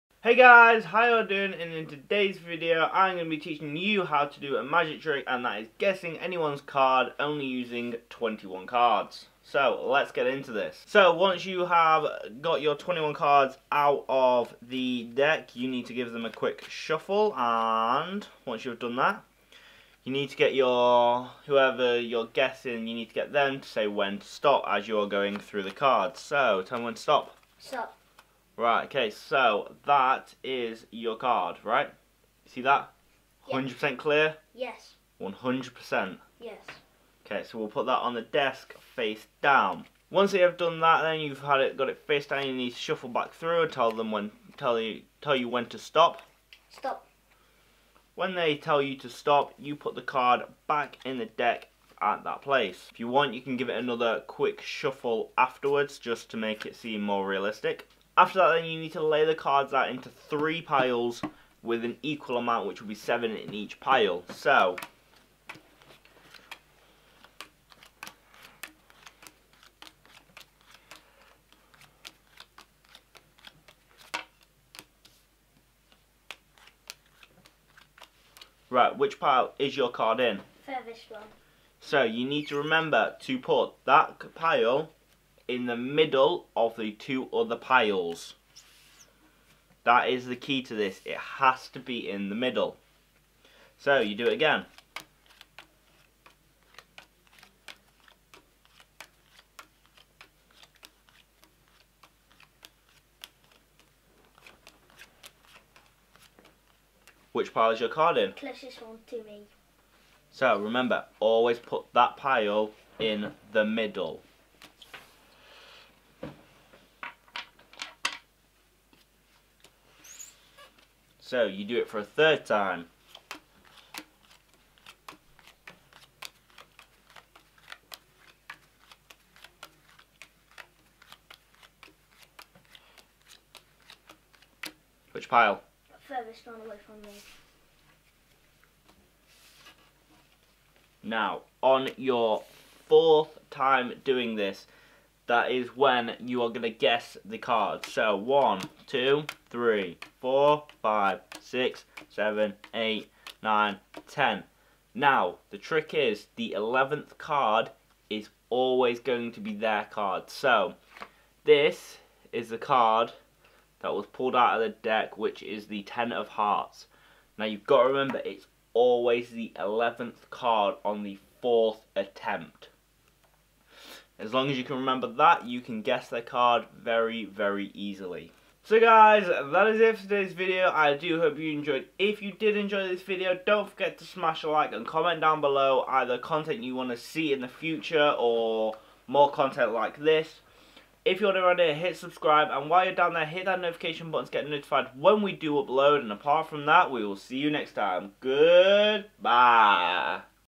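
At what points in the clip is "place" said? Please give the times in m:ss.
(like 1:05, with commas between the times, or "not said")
0:52.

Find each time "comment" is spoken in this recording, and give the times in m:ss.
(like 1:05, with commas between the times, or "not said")
3:04.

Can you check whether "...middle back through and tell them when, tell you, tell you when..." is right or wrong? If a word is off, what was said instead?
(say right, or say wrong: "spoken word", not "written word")
wrong: "shuffle", not "middle".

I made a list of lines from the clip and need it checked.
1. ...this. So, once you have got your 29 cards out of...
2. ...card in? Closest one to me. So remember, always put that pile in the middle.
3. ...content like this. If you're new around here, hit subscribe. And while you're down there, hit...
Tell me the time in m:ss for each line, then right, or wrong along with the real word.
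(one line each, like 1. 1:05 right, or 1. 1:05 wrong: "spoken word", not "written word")
1. 0:10 wrong: "21", not "29"
2. 1:47 right
3. 3:09 right.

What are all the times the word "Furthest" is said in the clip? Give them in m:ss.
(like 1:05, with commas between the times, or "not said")
1:20, 2:16.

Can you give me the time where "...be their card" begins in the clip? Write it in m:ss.
2:39.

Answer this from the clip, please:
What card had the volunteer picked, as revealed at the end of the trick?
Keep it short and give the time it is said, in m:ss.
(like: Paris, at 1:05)
Ten of Hearts, at 2:45.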